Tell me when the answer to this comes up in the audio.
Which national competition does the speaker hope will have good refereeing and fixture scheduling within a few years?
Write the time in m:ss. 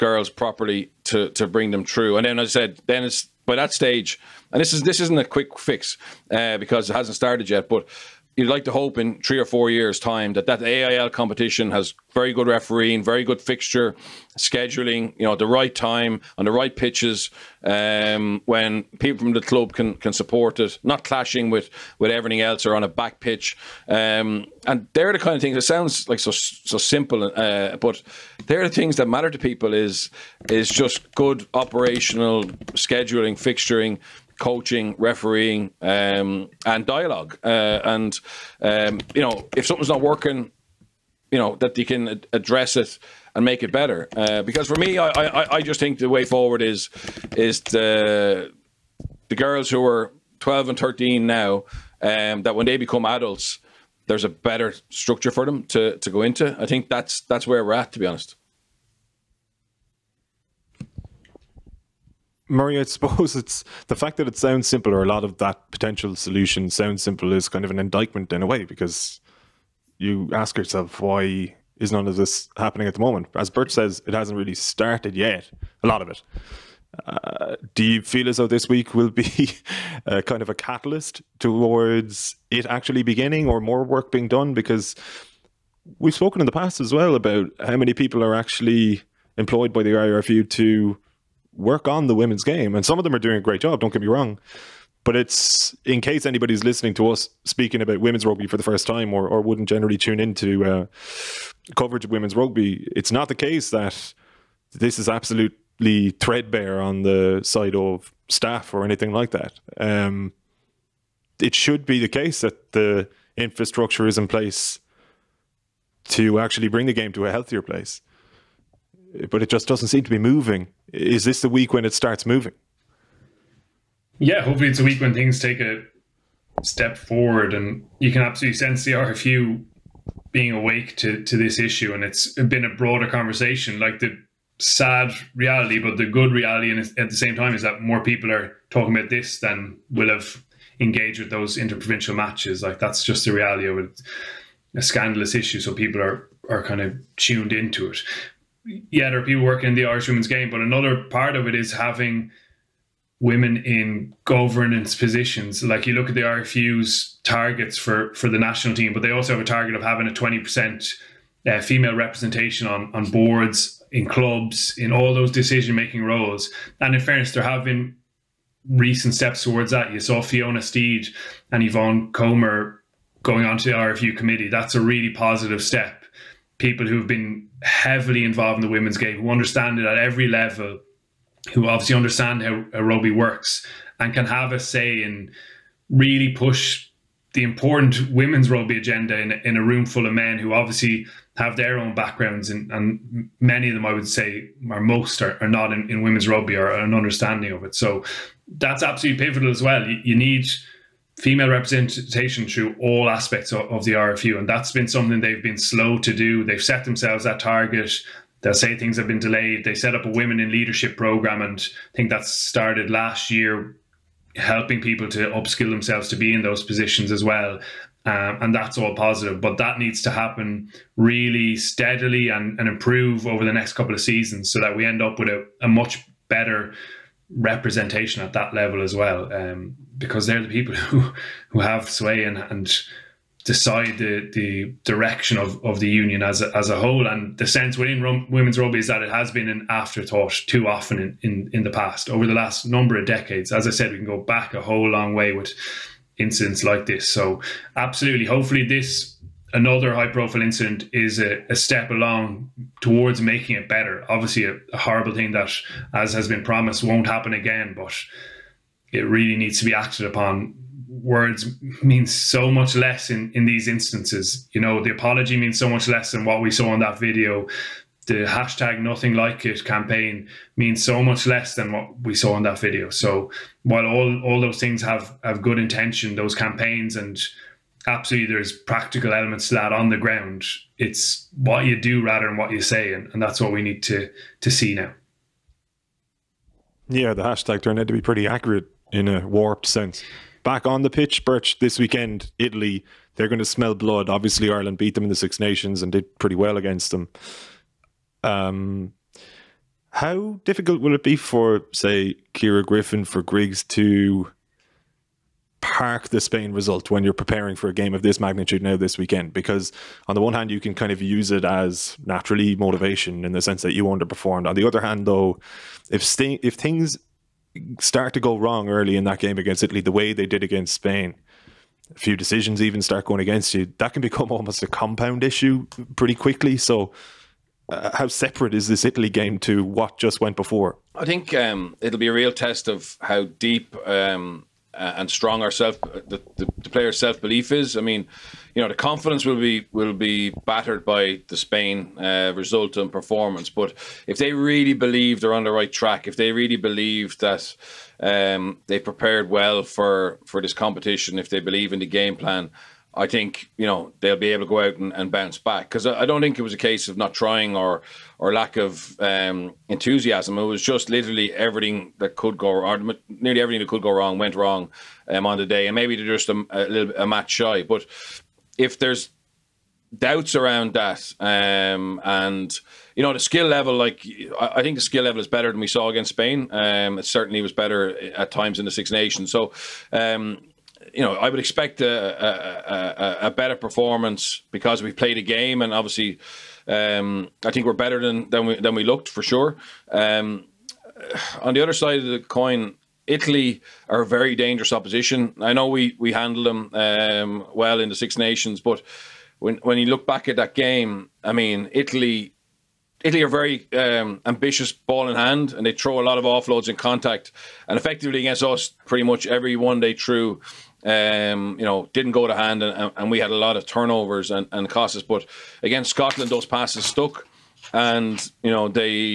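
0:10.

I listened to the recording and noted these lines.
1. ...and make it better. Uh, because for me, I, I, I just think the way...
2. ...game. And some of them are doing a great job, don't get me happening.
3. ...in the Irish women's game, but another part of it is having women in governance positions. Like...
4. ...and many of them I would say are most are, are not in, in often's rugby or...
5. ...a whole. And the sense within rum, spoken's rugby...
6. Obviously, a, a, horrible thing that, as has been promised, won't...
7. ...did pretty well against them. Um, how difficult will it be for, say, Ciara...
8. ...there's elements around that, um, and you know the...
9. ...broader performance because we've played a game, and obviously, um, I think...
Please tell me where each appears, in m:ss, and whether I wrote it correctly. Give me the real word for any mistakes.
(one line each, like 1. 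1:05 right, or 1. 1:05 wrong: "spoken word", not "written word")
1. 0:43 right
2. 1:32 wrong: "wrong", not "happening"
3. 2:29 right
4. 3:12 wrong: "women", not "often"
5. 3:56 wrong: "women", not "spoken"
6. 4:14 right
7. 4:55 right
8. 6:08 wrong: "doubts", not "elements"
9. 6:23 wrong: "better", not "broader".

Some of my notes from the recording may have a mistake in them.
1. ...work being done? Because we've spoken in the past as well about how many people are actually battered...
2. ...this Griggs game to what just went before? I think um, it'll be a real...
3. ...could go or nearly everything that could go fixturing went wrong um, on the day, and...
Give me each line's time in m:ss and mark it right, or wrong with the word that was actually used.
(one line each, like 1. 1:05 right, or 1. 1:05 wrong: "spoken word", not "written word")
1. 1:23 wrong: "employed", not "battered"
2. 5:28 wrong: "Italy", not "Griggs"
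3. 6:02 wrong: "wrong", not "fixturing".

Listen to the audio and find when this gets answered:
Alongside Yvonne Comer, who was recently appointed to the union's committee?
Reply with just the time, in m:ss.
2:50.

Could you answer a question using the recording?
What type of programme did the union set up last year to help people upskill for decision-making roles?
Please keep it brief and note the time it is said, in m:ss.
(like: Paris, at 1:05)
Women in leadership program, at 3:30.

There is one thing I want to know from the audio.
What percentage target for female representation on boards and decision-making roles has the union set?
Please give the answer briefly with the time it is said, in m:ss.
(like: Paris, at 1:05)
20%, at 2:40.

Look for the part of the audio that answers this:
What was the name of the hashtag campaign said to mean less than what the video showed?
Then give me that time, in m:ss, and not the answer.
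4:28.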